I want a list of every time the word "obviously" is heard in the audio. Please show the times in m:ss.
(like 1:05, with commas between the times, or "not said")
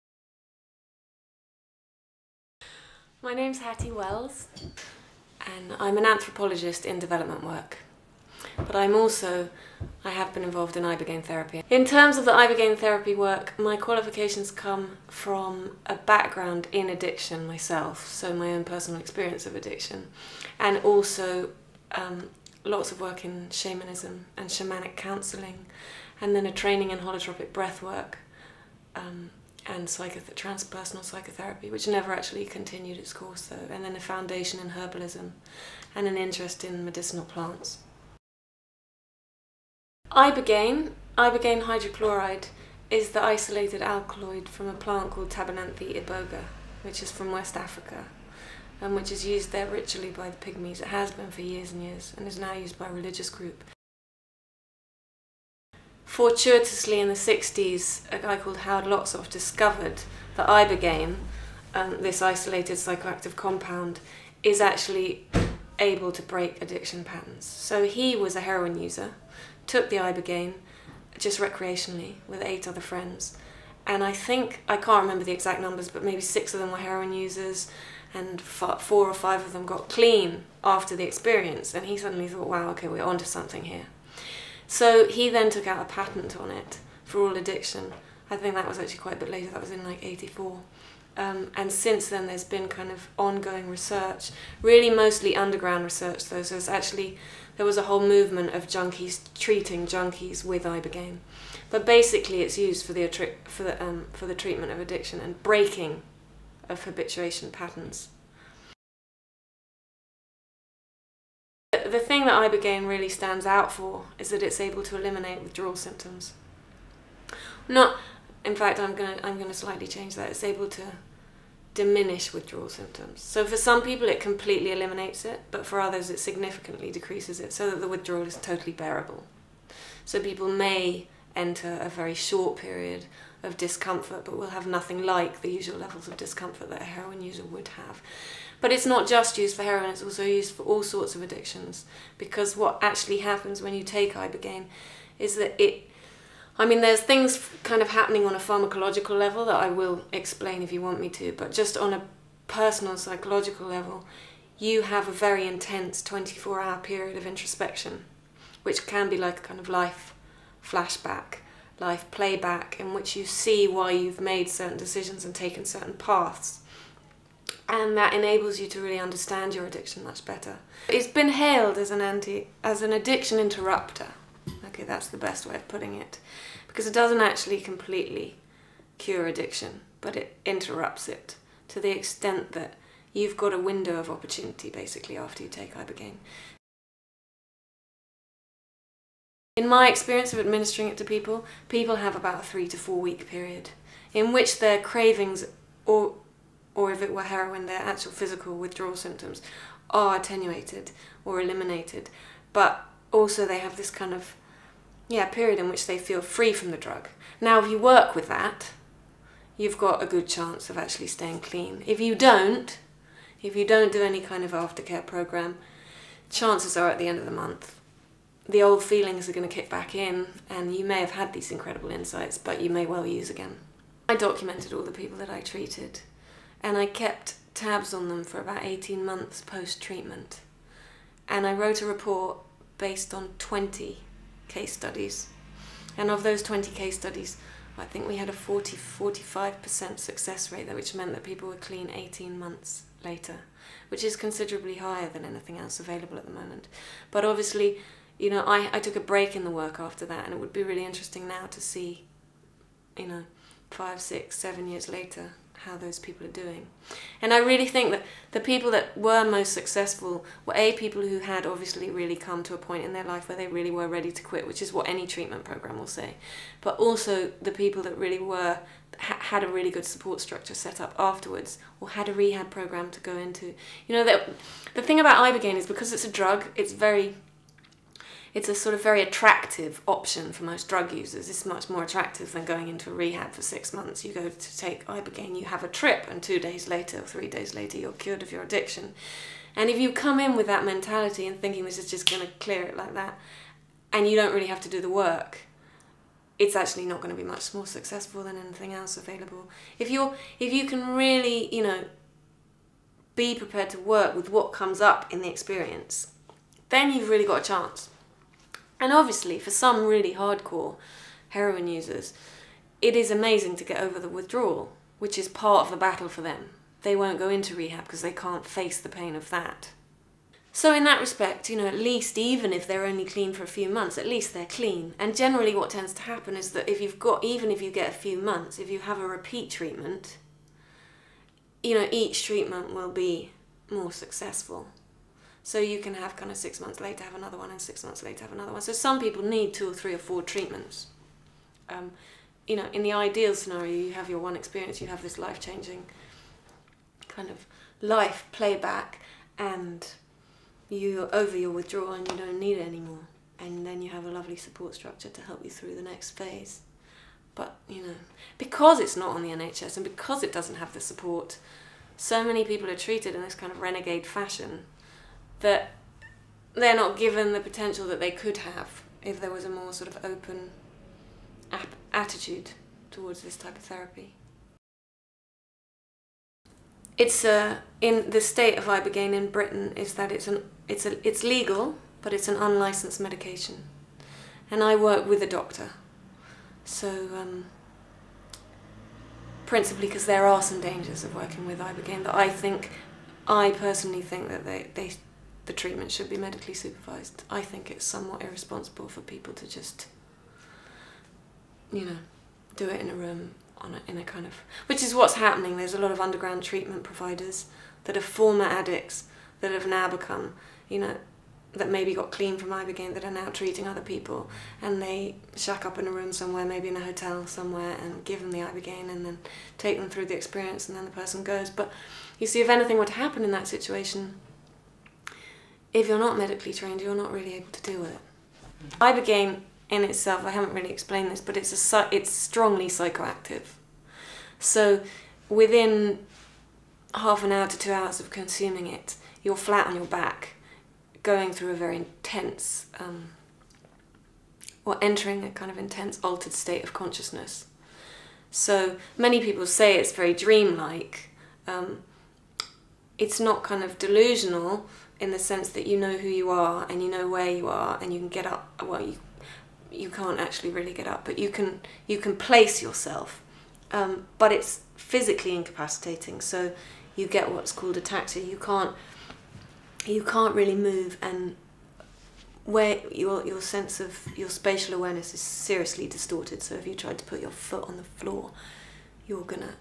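4:07, 4:21, 5:08.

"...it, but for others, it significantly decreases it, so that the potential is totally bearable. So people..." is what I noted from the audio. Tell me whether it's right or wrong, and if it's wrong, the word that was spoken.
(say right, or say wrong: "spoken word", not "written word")
wrong: "withdrawal", not "potential".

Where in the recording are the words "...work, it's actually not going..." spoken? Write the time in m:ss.
4:54.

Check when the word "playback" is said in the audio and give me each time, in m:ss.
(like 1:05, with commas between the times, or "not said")
2:42, 5:48.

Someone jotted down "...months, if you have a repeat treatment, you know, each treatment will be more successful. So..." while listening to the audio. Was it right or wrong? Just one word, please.
right.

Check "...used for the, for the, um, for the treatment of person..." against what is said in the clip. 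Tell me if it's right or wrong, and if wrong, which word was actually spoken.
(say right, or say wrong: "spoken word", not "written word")
wrong: "addiction", not "person".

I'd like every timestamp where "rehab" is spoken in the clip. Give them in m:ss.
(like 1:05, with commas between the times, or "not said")
4:32, 4:42, 5:17.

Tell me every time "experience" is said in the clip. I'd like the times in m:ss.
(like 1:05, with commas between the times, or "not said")
0:18, 1:21, 3:09, 5:05, 5:44, 7:00.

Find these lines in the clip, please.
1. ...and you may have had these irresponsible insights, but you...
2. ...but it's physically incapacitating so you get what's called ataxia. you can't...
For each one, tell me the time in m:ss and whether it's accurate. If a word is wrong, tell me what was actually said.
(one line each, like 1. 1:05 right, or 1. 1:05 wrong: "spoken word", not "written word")
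1. 3:40 wrong: "incredible", not "irresponsible"
2. 7:44 right.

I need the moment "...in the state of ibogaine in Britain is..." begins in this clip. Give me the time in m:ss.
6:17.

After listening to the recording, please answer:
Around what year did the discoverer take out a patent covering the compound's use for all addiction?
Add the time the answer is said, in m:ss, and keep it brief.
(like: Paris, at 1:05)
1984, at 1:30.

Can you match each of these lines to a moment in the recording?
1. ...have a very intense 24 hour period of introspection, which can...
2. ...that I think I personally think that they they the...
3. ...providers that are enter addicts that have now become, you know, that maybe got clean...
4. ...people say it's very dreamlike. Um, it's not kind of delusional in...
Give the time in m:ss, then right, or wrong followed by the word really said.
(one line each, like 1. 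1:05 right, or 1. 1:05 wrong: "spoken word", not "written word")
1. 2:34 right
2. 6:32 right
3. 6:46 wrong: "former", not "enter"
4. 7:29 right.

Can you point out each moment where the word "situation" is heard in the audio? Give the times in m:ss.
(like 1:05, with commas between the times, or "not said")
7:03.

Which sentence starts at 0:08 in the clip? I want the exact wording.
But I'm also, I have been involved in Ibogaine therapy.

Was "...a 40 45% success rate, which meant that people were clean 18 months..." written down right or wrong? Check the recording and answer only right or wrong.
right.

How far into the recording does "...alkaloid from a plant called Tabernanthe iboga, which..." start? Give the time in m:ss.
0:43.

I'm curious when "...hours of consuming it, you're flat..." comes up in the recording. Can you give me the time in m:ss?
7:17.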